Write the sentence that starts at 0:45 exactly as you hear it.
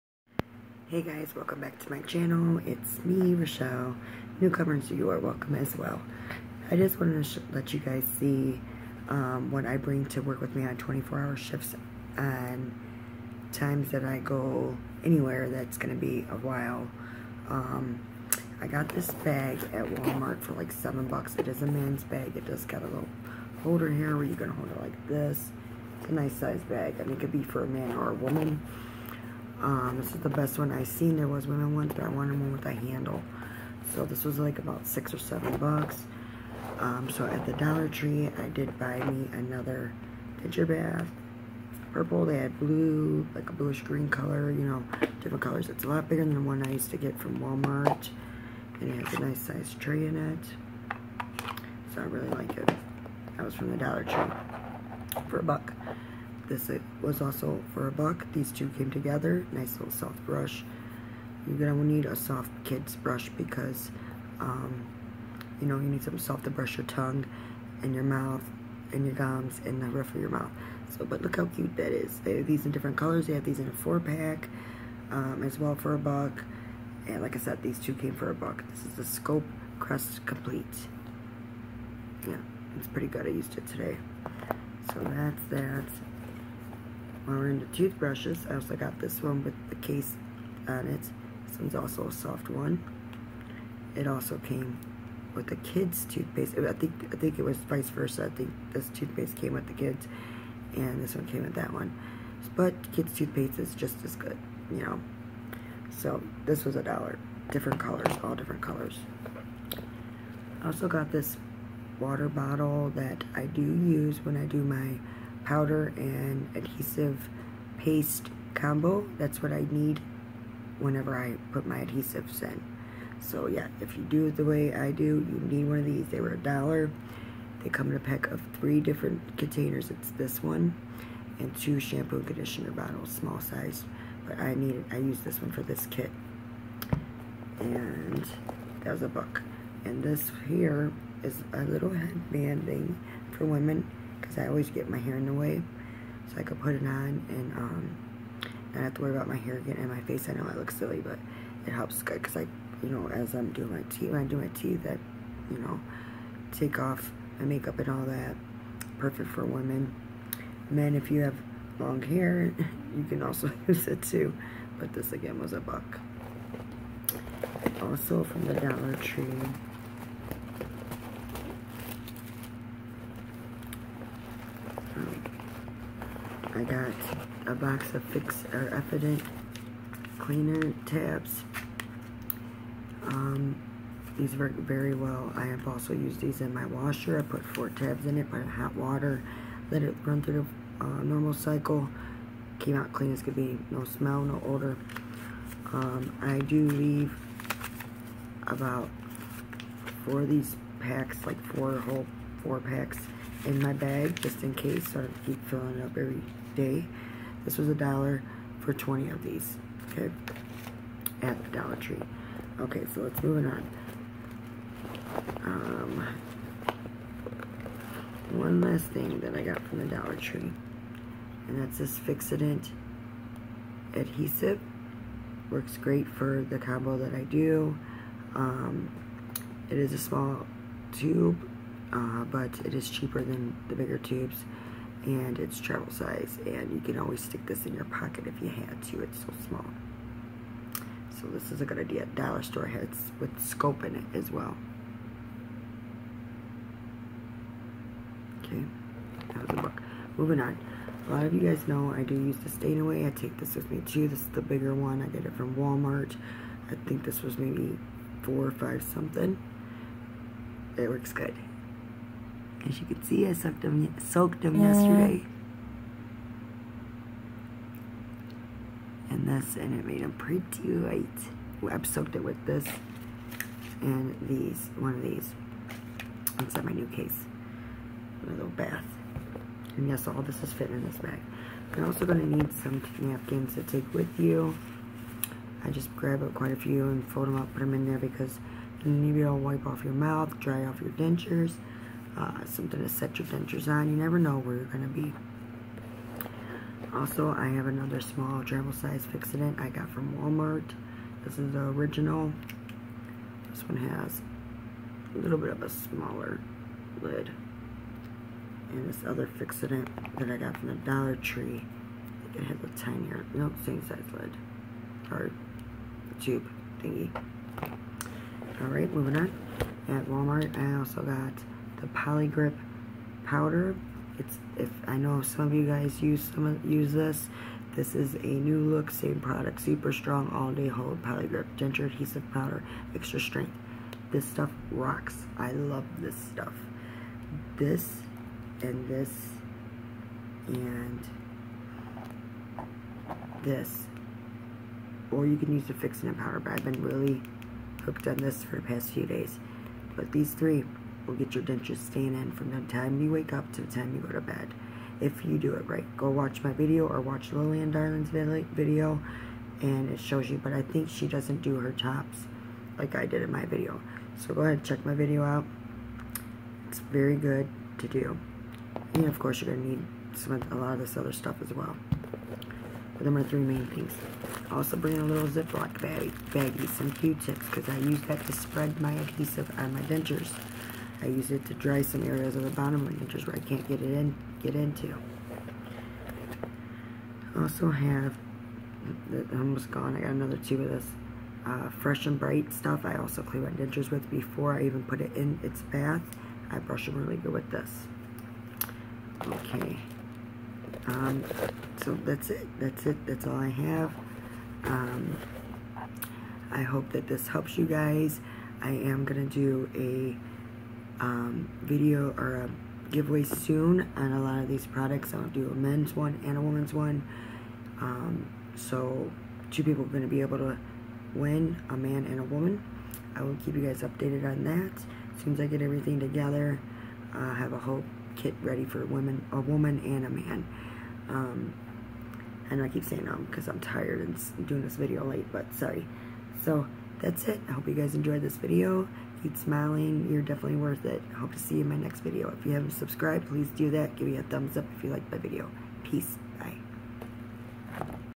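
It's a lot bigger than the one I used to get from Walmart.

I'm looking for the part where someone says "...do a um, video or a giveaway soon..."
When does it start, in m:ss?
6:49.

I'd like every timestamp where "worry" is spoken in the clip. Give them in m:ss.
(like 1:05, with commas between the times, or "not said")
2:29.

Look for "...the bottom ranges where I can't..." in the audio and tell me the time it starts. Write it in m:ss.
6:22.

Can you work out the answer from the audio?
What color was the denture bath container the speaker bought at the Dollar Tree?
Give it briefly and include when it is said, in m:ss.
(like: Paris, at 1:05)
Purple, at 0:41.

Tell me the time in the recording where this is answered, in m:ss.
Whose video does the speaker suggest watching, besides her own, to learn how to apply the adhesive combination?
5:57.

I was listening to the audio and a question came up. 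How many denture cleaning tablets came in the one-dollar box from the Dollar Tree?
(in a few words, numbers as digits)
20.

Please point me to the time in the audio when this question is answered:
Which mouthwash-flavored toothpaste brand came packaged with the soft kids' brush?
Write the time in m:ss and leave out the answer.
1:19.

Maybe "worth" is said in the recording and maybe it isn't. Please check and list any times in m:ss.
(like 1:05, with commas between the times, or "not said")
7:20.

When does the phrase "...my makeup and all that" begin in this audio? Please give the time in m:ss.
2:37.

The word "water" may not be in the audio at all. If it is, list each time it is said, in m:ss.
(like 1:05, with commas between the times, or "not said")
1:51, 3:08.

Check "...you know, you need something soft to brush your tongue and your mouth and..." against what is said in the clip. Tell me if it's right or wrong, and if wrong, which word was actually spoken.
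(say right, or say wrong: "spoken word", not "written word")
right.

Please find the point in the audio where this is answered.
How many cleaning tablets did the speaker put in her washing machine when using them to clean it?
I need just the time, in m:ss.
3:07.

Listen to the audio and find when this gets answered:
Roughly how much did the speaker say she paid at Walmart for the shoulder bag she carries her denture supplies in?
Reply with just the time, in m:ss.
0:20.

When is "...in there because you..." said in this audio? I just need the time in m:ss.
4:47.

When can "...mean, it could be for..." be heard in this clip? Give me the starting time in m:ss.
0:27.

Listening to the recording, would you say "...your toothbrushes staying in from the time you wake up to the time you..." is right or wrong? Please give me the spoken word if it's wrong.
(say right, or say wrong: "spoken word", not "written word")
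wrong: "dentures", not "toothbrushes".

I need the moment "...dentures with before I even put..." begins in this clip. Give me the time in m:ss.
6:33.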